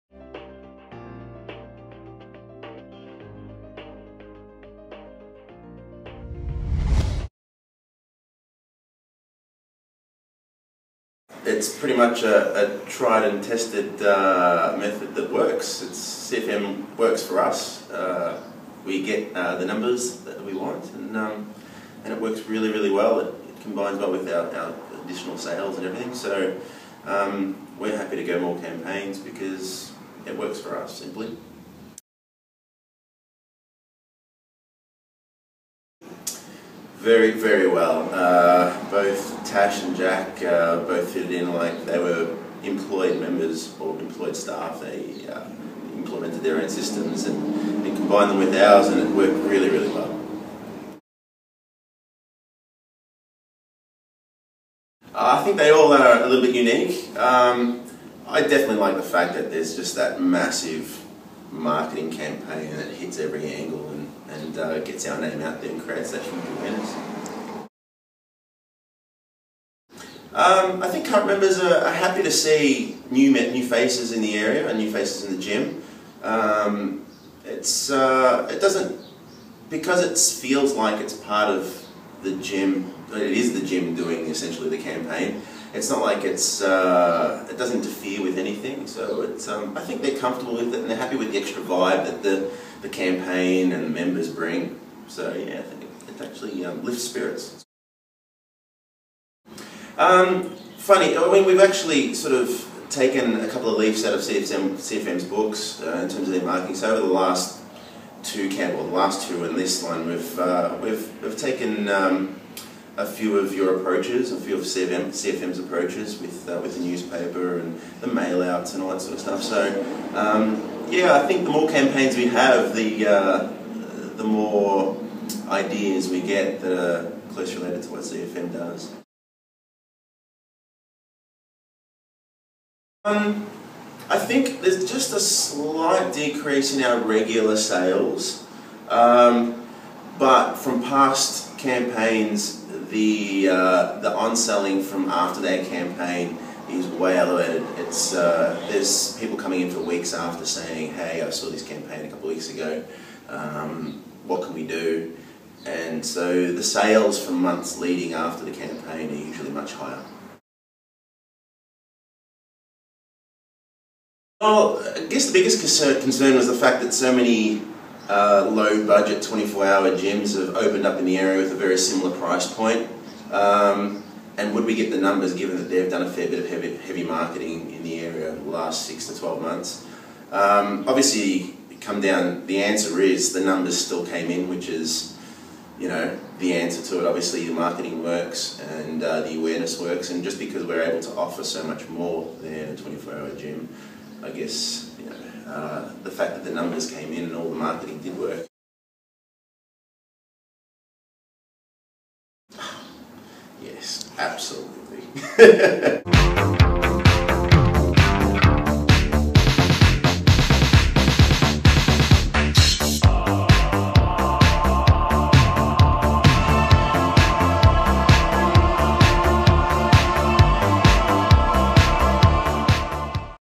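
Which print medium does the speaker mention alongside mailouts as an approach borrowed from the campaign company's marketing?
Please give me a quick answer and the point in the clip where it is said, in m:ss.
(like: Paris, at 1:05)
newspaper, at 1:56.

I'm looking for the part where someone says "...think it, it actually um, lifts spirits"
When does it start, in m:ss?
1:35.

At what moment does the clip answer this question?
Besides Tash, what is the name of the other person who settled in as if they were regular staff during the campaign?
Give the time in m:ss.
0:39.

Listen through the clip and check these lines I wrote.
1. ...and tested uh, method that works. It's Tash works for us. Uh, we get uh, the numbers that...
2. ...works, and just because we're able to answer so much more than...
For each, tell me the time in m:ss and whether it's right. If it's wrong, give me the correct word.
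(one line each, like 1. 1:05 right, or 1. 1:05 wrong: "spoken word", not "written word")
1. 0:13 wrong: "CFM", not "Tash"
2. 3:09 wrong: "offer", not "answer".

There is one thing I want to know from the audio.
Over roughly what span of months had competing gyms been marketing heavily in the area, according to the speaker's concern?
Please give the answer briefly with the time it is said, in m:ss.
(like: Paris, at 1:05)
6 to 12 months, at 2:58.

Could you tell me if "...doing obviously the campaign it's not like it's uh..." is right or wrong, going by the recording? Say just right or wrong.
wrong.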